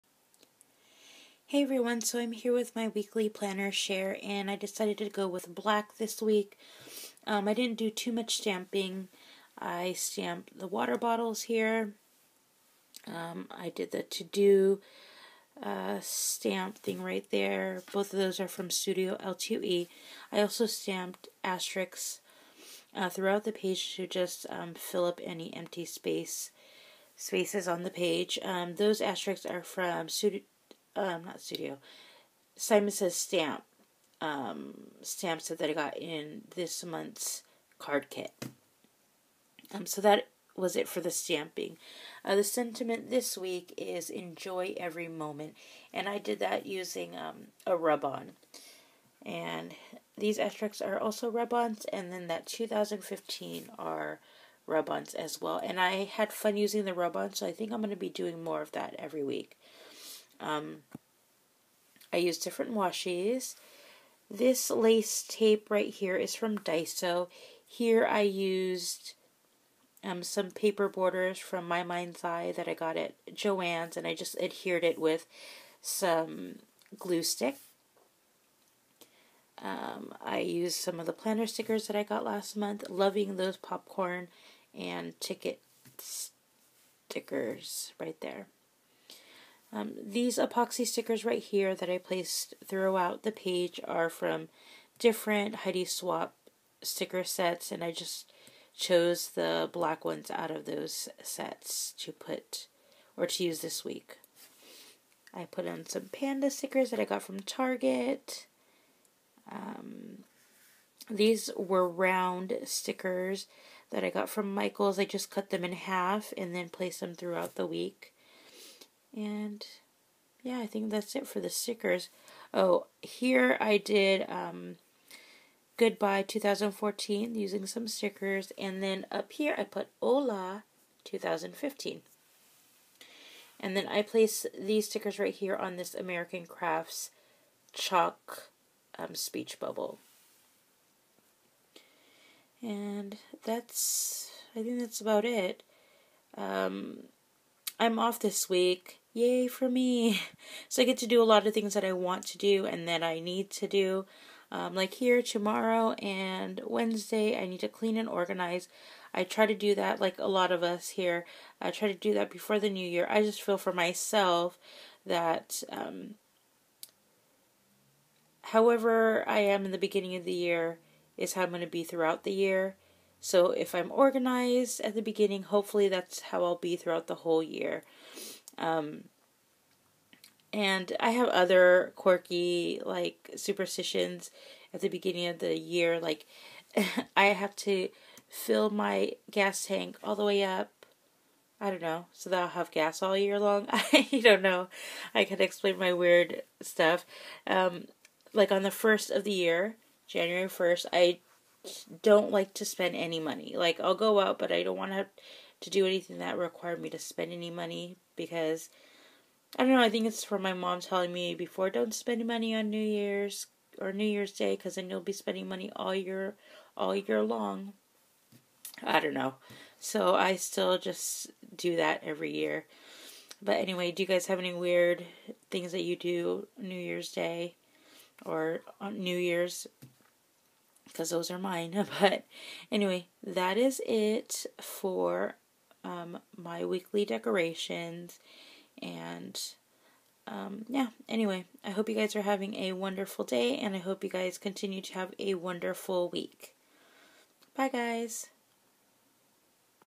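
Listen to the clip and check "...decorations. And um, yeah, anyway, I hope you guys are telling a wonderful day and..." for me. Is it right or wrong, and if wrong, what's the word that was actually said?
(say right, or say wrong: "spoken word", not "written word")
wrong: "having", not "telling".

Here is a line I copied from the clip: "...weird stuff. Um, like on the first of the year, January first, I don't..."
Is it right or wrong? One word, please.
right.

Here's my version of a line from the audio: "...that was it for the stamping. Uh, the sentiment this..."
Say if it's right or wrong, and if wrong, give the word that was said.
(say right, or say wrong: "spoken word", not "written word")
right.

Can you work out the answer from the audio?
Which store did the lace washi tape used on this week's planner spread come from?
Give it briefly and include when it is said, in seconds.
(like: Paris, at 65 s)
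Daiso, at 66 s.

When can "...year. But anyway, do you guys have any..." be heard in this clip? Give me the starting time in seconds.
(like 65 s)
222 s.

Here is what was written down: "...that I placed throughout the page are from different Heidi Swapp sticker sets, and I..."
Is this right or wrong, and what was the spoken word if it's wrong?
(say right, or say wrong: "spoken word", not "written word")
right.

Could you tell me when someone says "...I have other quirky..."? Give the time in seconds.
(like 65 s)
180 s.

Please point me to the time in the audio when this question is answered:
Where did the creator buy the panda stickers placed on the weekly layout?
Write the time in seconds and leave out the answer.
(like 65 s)
107 s.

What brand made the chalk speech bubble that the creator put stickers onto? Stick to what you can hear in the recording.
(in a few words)
American Crafts.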